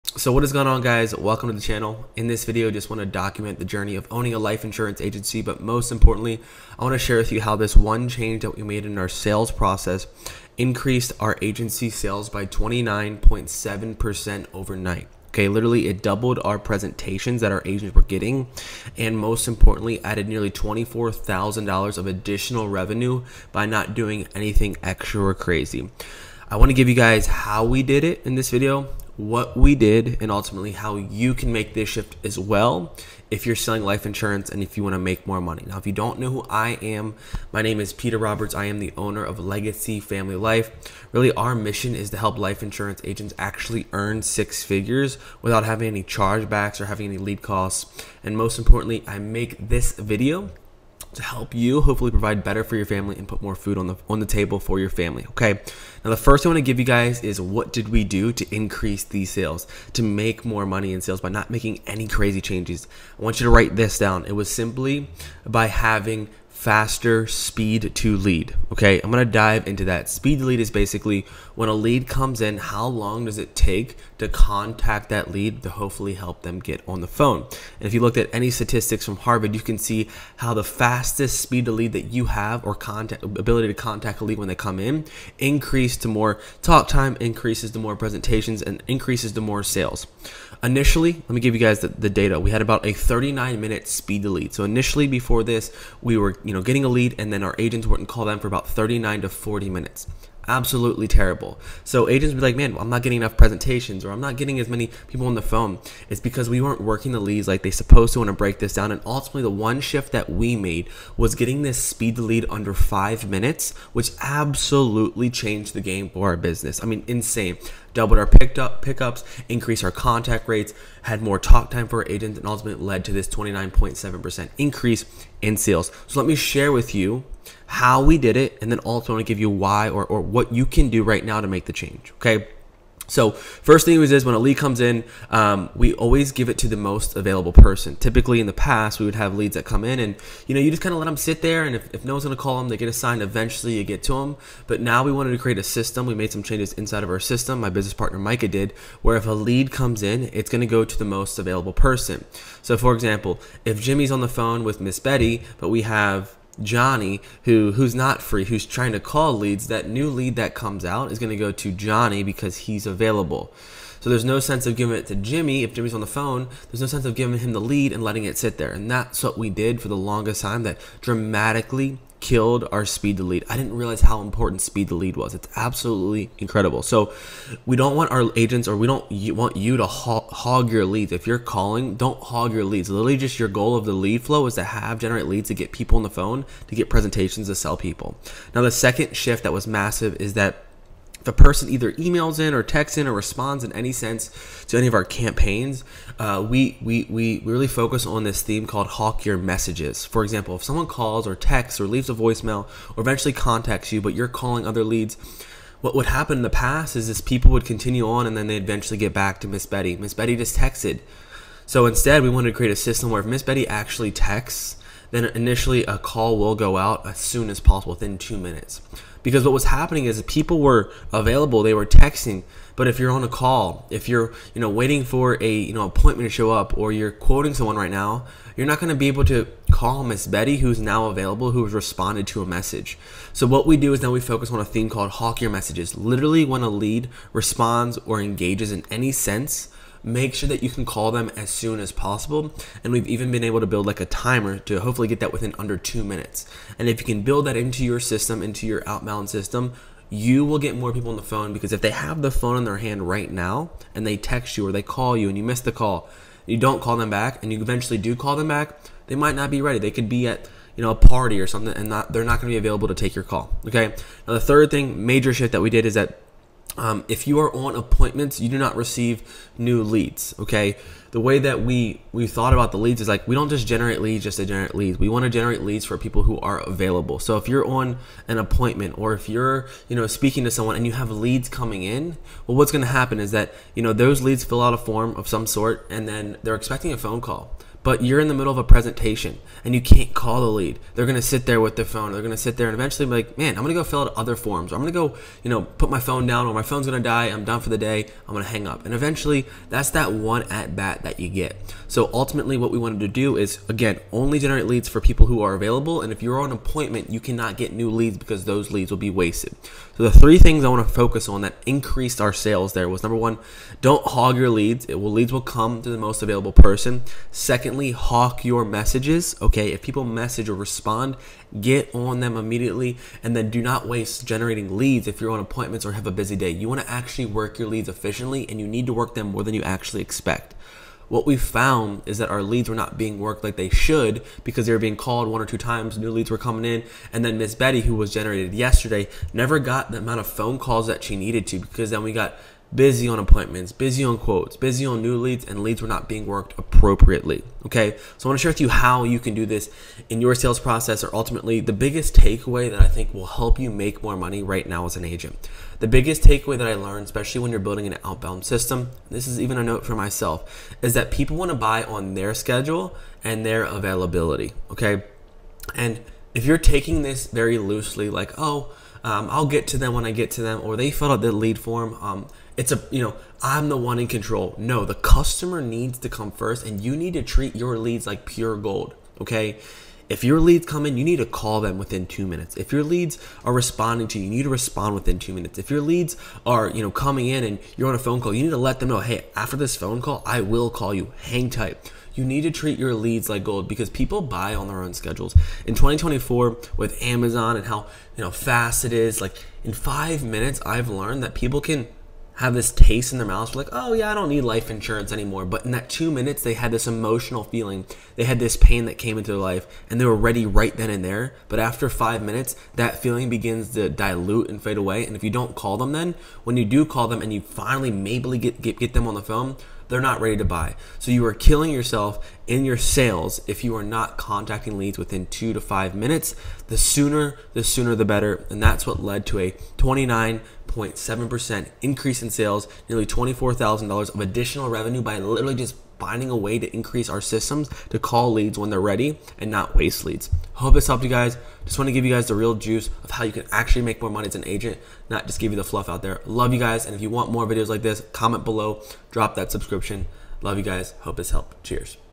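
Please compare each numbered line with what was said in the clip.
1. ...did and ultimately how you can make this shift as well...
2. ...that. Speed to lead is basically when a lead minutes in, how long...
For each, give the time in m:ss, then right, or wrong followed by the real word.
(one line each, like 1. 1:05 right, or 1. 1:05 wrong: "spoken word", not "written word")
1. 0:29 right
2. 1:09 wrong: "comes", not "minutes".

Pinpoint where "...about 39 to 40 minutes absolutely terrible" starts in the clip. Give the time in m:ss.
1:38.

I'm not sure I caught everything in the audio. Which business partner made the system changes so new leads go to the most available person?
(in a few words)
Micah.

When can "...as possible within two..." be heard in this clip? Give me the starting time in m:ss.
3:37.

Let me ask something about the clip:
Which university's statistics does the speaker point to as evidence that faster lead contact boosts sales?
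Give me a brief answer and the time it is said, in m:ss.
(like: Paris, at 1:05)
Harvard, at 1:19.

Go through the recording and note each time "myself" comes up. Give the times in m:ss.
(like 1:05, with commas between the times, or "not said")
5:59.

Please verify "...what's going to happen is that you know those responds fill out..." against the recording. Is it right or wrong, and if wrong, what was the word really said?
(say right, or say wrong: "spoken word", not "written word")
wrong: "leads", not "responds".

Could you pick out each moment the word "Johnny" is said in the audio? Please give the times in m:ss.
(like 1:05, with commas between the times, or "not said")
2:36, 2:41.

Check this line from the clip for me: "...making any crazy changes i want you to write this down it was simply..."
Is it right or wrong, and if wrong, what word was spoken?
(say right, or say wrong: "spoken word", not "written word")
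right.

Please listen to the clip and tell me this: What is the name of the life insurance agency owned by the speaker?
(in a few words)
Legacy Family Life.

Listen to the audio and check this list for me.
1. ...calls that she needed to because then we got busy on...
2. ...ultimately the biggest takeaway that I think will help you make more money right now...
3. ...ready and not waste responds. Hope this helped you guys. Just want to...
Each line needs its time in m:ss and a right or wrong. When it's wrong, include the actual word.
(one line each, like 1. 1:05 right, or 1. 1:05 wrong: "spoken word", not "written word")
1. 5:40 right
2. 5:51 right
3. 7:18 wrong: "leads", not "responds".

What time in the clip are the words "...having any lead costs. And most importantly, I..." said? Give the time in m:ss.
0:46.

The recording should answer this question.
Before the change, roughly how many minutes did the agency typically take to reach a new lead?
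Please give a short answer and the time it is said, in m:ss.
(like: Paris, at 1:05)
39, at 1:32.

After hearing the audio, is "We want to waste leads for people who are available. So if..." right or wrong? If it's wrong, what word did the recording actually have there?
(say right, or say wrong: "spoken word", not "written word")
wrong: "generate", not "waste".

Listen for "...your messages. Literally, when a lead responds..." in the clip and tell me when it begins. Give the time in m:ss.
3:55.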